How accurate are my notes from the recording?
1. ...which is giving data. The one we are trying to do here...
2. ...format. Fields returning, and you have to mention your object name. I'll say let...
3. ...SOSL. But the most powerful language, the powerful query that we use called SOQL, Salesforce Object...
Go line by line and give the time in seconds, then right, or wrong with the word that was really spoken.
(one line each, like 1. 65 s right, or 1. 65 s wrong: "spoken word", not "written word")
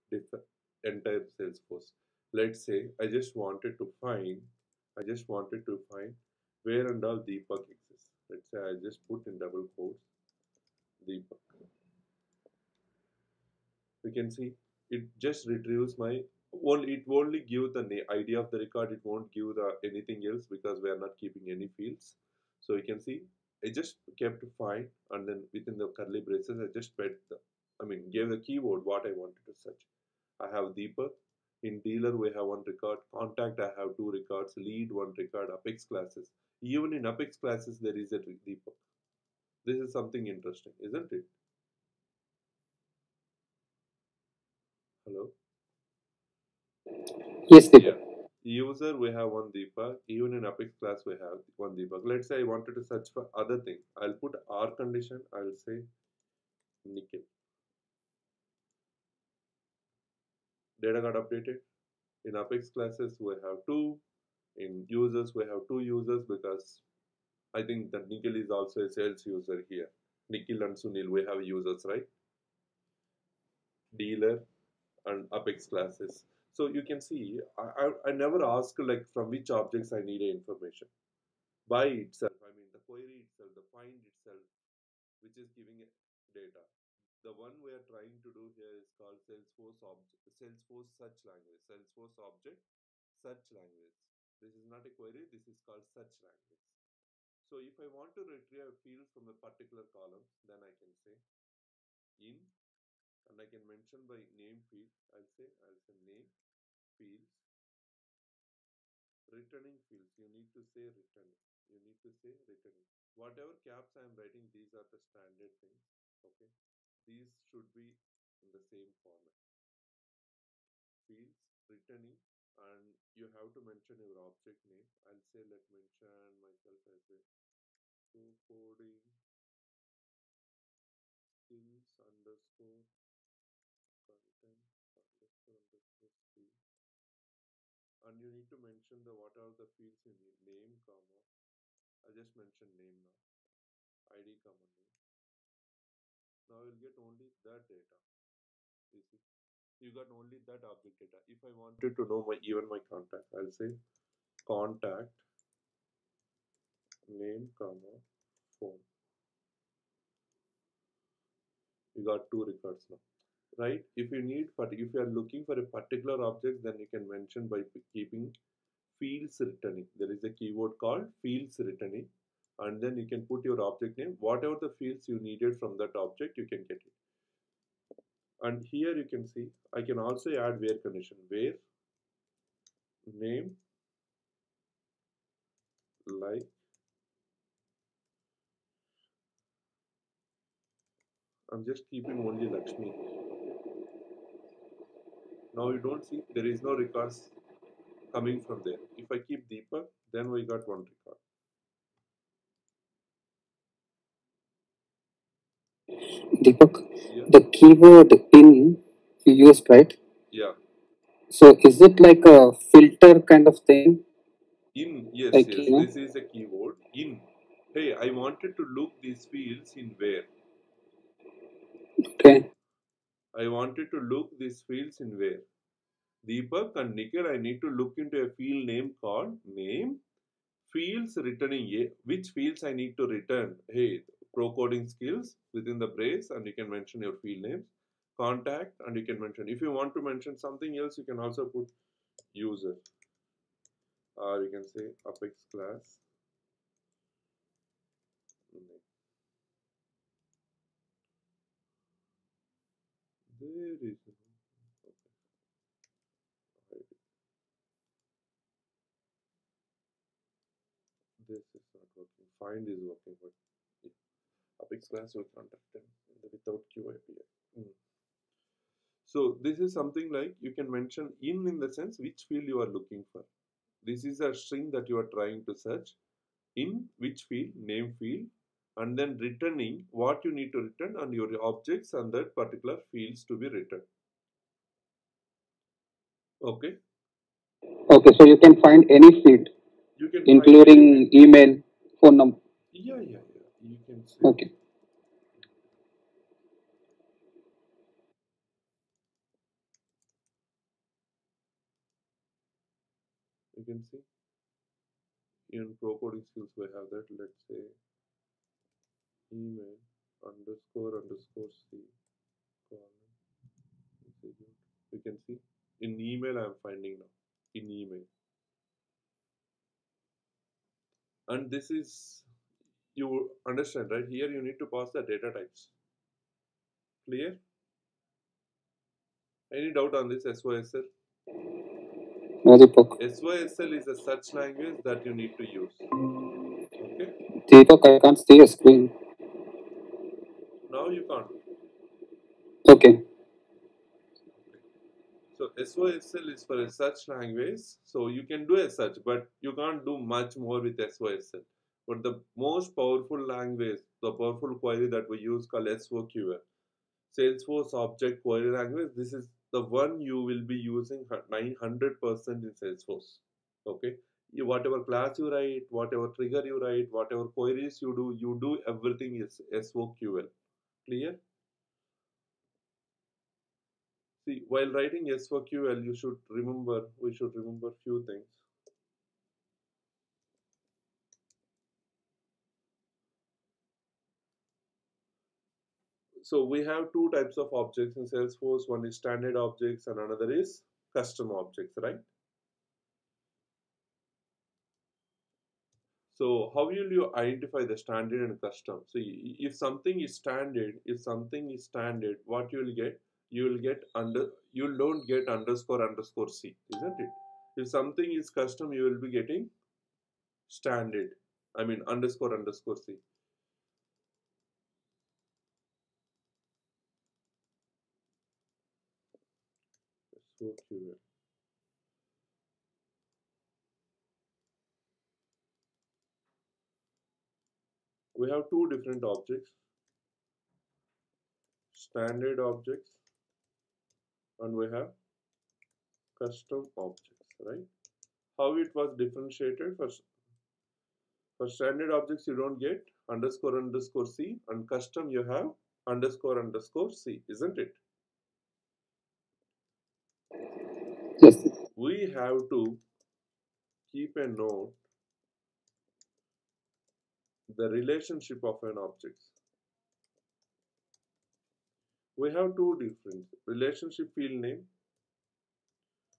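1. 85 s right
2. 119 s right
3. 350 s right.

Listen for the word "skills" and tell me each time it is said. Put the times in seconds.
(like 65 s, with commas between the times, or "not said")
131 s, 234 s, 306 s.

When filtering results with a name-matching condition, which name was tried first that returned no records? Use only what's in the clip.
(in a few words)
Lakshmi.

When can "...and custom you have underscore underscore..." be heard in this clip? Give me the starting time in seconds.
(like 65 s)
444 s.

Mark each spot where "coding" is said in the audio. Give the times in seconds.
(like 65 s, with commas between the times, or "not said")
128 s, 234 s, 305 s.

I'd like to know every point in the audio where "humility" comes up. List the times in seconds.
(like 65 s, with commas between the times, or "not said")
not said.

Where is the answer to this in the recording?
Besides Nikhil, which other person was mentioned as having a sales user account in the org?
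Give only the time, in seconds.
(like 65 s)
70 s.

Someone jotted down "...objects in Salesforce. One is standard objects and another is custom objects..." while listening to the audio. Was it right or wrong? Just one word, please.
right.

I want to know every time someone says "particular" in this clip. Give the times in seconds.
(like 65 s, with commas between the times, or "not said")
99 s, 165 s, 282 s.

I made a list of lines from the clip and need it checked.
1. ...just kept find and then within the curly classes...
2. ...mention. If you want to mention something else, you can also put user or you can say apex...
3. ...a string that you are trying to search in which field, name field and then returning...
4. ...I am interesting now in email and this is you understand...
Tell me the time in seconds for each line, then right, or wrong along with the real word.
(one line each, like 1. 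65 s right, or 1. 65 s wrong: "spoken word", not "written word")
1. 23 s wrong: "braces", not "classes"
2. 239 s right
3. 274 s right
4. 316 s wrong: "finding", not "interesting".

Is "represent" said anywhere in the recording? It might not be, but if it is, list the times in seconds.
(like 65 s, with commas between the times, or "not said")
not said.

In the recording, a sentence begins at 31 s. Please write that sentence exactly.
In dealer, we have one record.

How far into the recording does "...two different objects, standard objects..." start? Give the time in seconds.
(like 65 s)
428 s.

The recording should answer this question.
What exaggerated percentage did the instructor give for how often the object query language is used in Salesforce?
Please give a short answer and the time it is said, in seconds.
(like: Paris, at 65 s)
900%, at 361 s.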